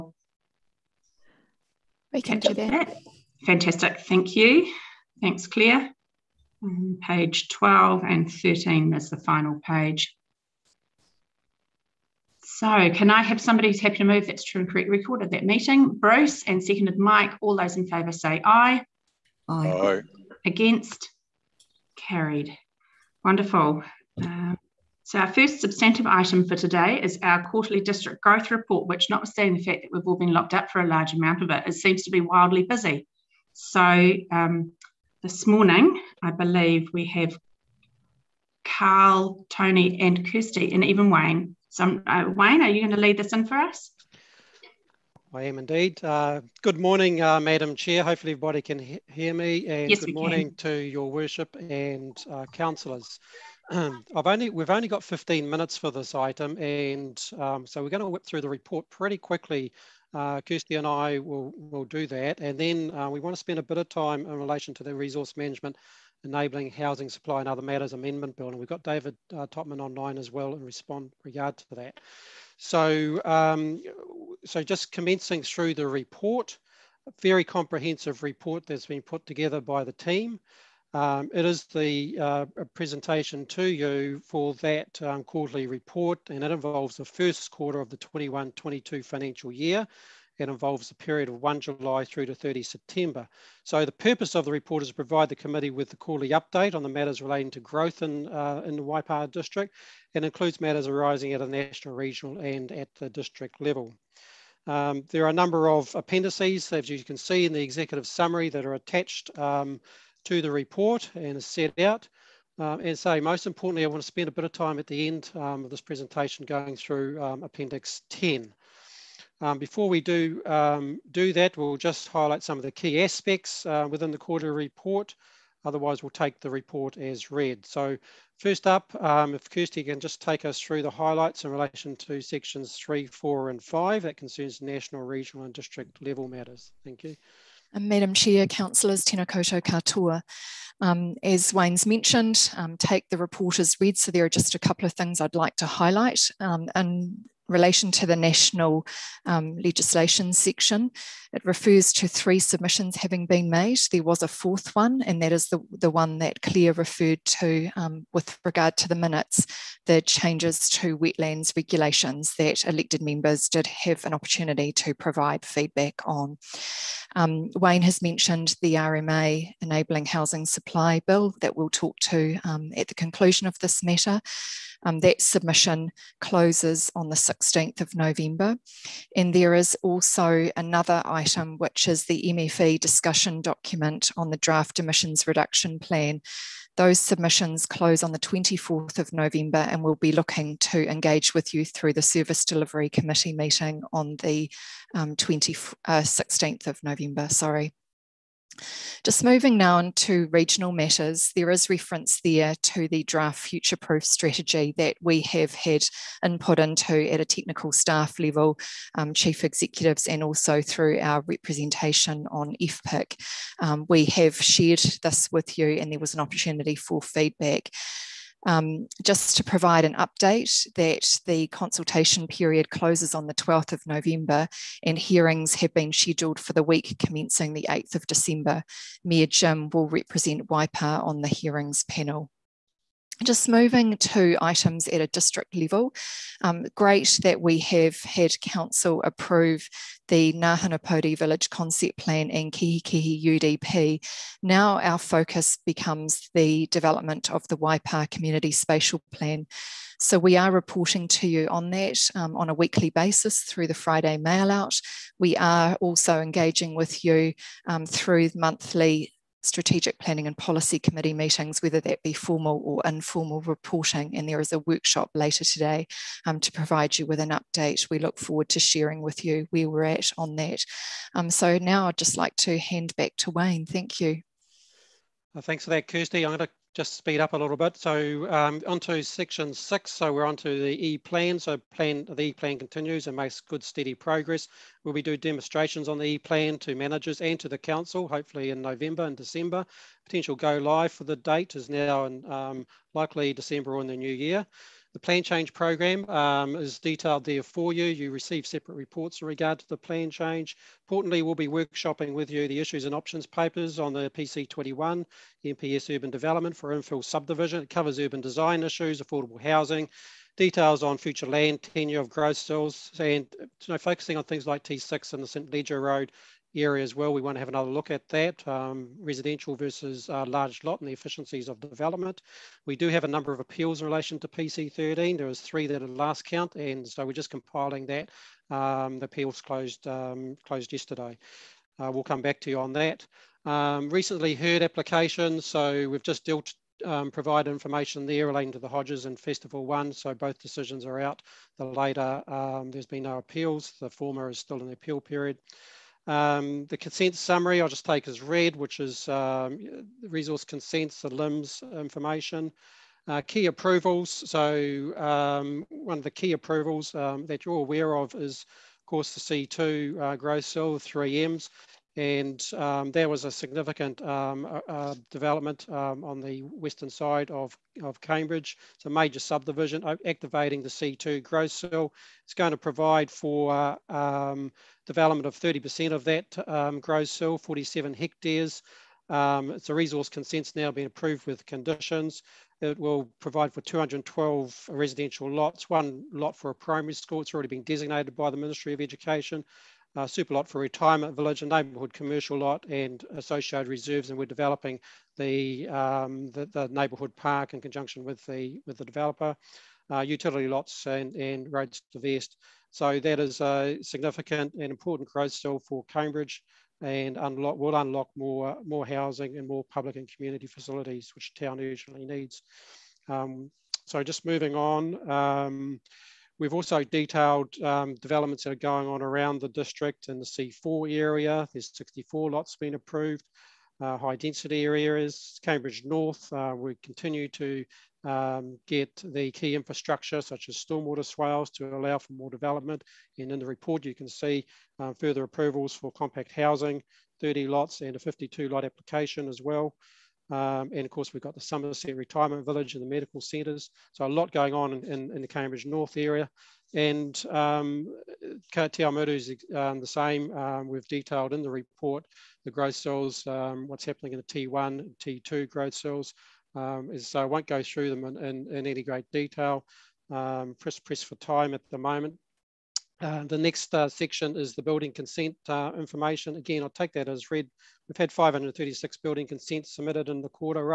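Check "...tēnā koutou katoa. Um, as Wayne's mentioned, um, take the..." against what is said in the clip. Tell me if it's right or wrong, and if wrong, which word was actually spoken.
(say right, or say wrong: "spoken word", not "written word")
right.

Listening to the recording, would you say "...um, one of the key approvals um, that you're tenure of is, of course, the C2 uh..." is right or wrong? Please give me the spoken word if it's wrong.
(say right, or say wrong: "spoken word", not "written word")
wrong: "aware", not "tenure".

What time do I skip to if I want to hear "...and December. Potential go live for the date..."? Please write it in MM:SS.
04:49.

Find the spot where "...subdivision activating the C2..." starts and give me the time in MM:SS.
06:09.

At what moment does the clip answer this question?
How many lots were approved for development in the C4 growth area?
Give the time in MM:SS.
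07:01.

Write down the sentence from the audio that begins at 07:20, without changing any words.
Um, and of course, we've got the Somerset Retirement Village and the medical centres.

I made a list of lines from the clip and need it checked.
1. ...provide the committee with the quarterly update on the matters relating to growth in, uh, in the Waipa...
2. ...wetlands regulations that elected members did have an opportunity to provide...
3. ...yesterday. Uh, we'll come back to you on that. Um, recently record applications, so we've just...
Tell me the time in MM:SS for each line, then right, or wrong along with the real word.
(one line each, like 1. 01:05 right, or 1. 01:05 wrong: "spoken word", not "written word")
1. 01:34 right
2. 02:40 right
3. 05:30 wrong: "heard", not "record".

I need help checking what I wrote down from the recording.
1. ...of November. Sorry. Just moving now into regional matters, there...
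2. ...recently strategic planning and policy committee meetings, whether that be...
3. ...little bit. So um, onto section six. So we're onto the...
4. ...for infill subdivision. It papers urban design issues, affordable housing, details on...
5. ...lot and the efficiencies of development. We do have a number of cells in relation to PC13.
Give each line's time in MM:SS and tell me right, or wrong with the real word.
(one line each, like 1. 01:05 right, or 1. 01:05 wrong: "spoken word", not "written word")
1. 03:16 right
2. 04:18 wrong: "monthly", not "recently"
3. 04:37 right
4. 05:06 wrong: "covers", not "papers"
5. 05:20 wrong: "appeals", not "cells".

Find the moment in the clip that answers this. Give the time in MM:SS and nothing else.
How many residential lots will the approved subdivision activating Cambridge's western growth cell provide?
06:23.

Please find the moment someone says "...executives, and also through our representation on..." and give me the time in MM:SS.
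03:29.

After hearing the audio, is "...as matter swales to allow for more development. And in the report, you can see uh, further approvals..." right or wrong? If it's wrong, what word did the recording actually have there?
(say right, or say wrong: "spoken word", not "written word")
wrong: "stormwater", not "matter".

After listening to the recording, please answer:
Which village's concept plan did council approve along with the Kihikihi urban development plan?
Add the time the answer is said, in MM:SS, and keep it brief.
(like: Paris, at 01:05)
Ngāhinapōuri, at 04:00.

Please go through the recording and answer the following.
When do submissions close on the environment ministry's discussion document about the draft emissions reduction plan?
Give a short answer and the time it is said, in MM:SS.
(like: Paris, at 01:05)
24th of November, at 03:08.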